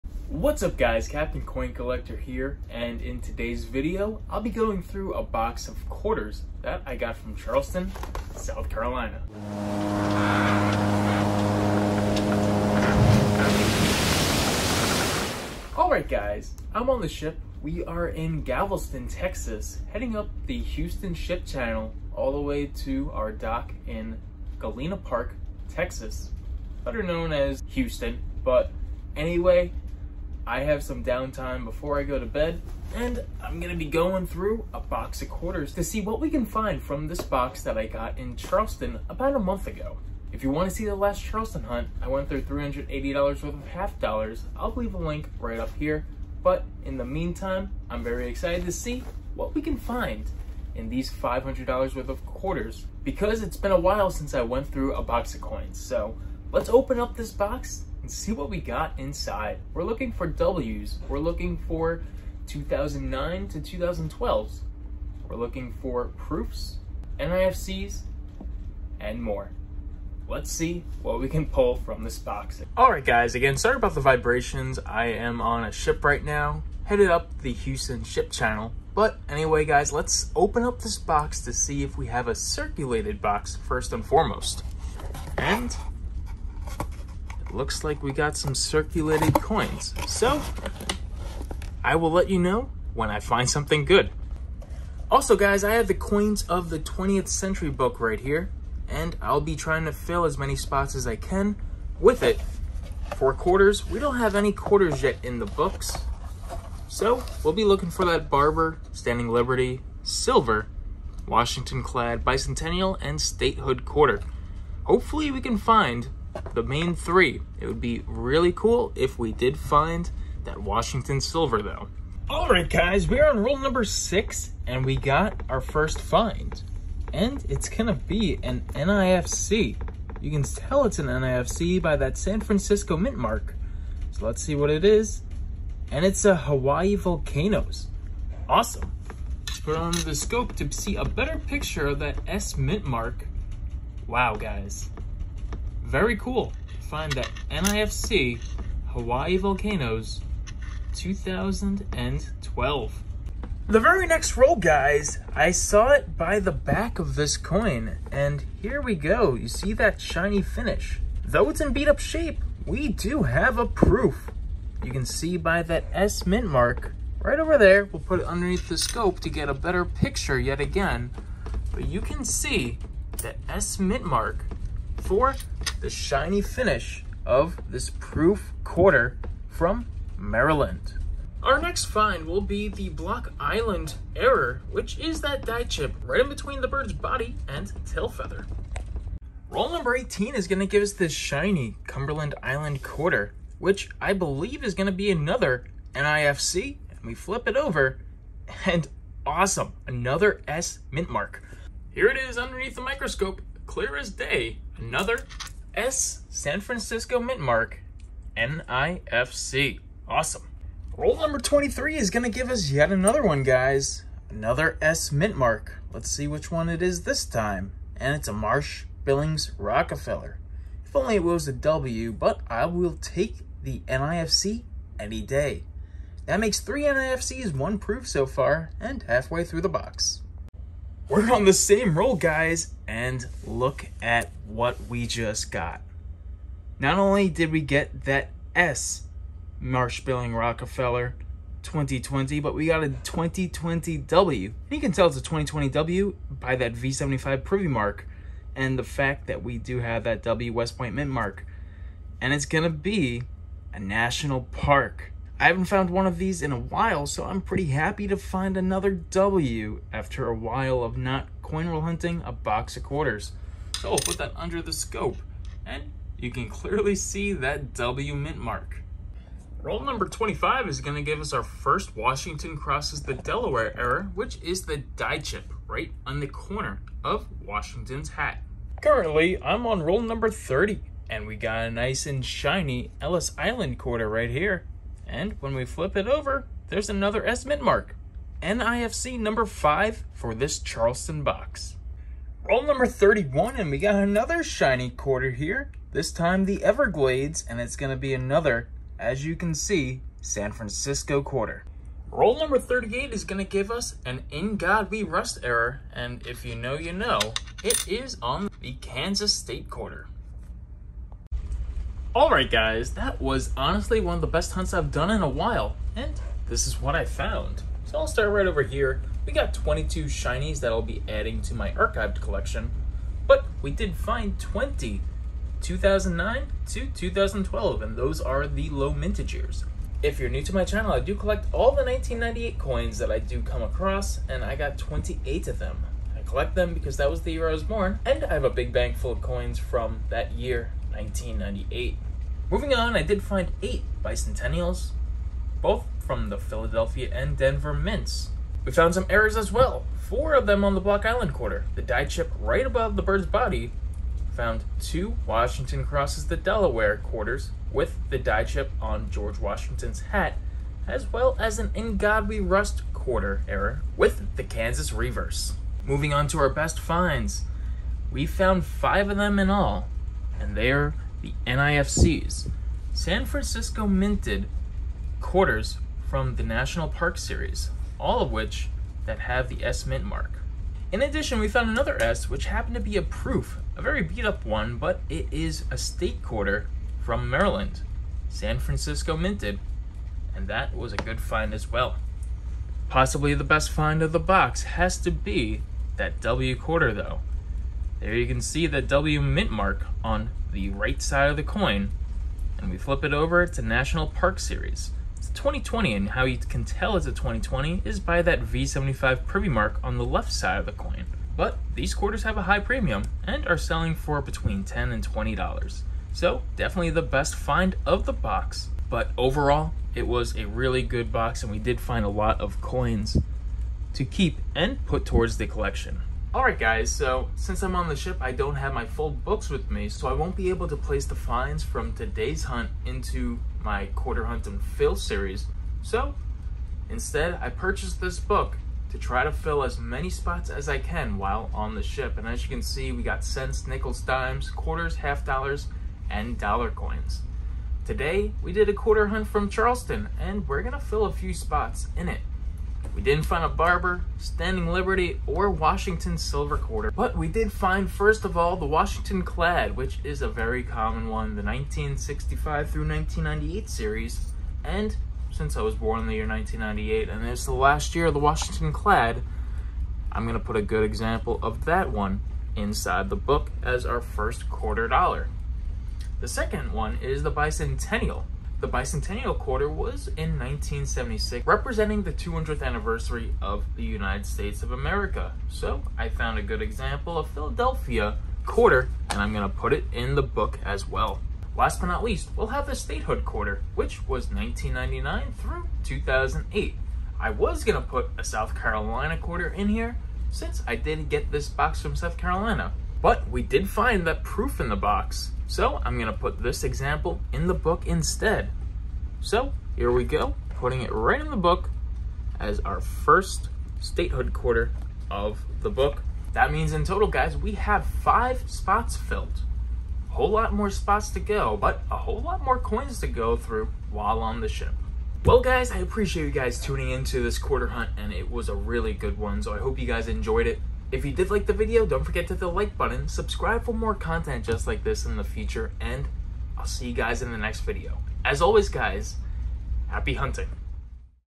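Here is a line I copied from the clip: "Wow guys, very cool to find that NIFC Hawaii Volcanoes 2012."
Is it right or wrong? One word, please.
right.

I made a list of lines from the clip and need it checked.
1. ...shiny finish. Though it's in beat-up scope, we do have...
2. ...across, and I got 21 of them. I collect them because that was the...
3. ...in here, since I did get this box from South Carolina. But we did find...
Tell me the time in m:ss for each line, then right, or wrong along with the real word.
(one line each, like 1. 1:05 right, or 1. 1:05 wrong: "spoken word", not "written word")
1. 2:39 wrong: "shape", not "scope"
2. 5:33 wrong: "28", not "21"
3. 8:19 right.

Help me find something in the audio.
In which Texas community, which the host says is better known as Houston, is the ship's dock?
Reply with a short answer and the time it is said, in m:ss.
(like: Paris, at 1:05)
Galena Park, at 0:24.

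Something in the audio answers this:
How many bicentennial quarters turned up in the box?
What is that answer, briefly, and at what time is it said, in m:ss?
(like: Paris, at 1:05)
8, at 5:43.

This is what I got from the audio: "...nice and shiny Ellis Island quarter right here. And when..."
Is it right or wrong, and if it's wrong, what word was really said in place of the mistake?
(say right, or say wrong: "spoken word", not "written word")
right.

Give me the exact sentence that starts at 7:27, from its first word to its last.
Today, we did a quarter hunt from Charleston, and we're gonna fill a few spots in it.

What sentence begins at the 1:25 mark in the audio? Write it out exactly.
And looks like we got some circulated coins.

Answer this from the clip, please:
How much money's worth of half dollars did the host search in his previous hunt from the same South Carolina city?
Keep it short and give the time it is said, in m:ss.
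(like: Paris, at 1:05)
$380, at 0:42.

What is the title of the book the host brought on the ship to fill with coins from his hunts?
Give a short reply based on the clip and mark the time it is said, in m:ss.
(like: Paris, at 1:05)
Coins of the 20th Century, at 1:35.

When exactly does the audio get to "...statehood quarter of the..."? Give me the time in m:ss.
8:33.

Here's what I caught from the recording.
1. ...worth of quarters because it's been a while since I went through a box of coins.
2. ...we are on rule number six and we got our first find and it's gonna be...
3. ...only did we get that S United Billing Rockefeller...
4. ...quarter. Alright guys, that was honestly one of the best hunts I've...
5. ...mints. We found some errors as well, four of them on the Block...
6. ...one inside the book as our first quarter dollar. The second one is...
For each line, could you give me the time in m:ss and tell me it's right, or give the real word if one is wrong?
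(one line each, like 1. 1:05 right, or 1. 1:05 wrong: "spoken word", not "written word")
1. 0:51 right
2. 2:03 right
3. 3:56 wrong: "Marsh", not "United"
4. 5:09 right
5. 5:47 right
6. 7:51 right.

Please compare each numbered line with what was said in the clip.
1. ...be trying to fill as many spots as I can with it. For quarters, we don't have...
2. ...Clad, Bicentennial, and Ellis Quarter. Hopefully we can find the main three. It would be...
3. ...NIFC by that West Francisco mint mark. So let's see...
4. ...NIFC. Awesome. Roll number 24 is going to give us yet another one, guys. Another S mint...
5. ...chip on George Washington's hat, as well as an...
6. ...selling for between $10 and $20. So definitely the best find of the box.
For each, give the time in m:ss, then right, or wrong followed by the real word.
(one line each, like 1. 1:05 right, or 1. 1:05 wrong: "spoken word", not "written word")
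1. 1:39 right
2. 1:51 wrong: "Statehood", not "Ellis"
3. 2:11 wrong: "San", not "West"
4. 3:28 wrong: "23", not "24"
5. 5:58 right
6. 6:53 right.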